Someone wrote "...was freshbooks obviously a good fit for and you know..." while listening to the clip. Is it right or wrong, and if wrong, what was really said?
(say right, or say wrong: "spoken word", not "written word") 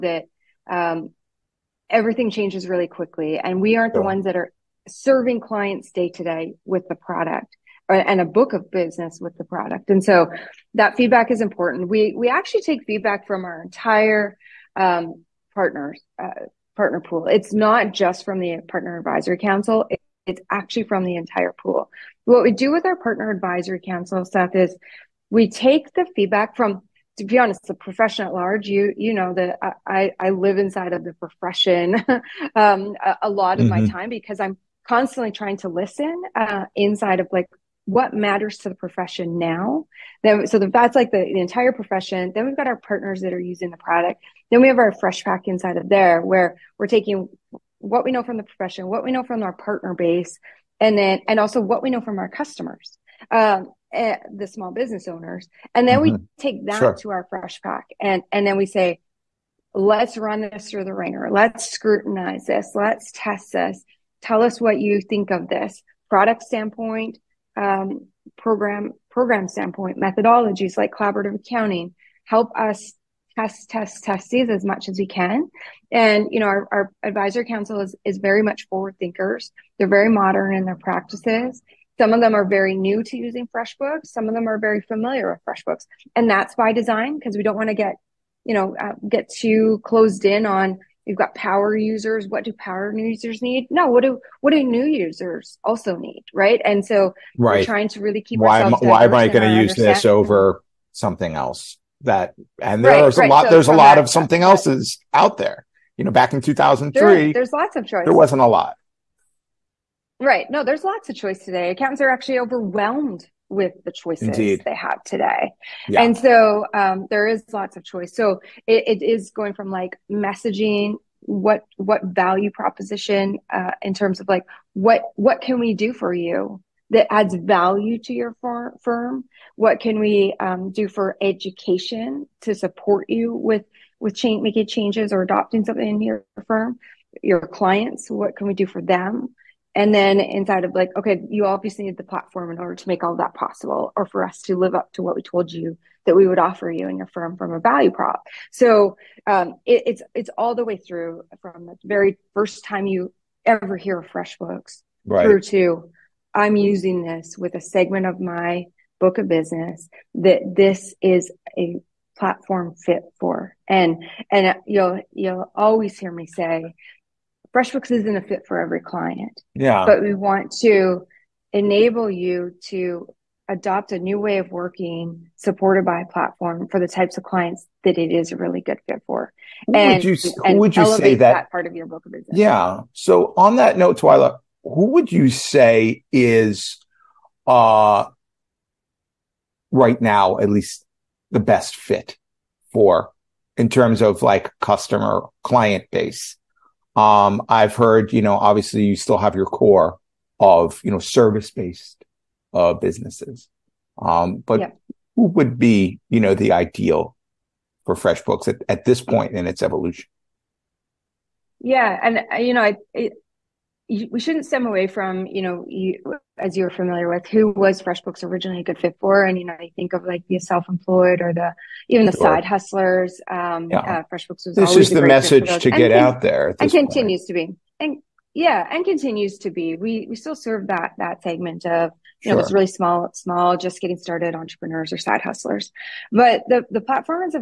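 wrong: "originally", not "obviously".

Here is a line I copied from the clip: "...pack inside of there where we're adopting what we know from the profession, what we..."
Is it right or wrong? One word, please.
wrong.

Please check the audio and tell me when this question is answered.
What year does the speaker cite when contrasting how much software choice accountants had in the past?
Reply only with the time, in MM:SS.
01:46.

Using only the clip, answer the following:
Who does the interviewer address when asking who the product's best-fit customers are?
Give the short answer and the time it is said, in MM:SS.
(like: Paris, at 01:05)
Twyla, at 03:03.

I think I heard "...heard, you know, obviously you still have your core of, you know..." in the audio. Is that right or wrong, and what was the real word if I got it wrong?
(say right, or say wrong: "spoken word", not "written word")
right.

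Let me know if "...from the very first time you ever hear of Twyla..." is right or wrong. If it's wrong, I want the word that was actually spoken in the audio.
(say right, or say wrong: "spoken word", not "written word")
wrong: "FreshBooks", not "Twyla".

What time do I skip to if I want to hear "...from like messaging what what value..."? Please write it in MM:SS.
01:59.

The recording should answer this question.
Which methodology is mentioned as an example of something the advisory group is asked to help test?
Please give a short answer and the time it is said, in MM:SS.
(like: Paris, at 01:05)
collaborative accounting, at 01:10.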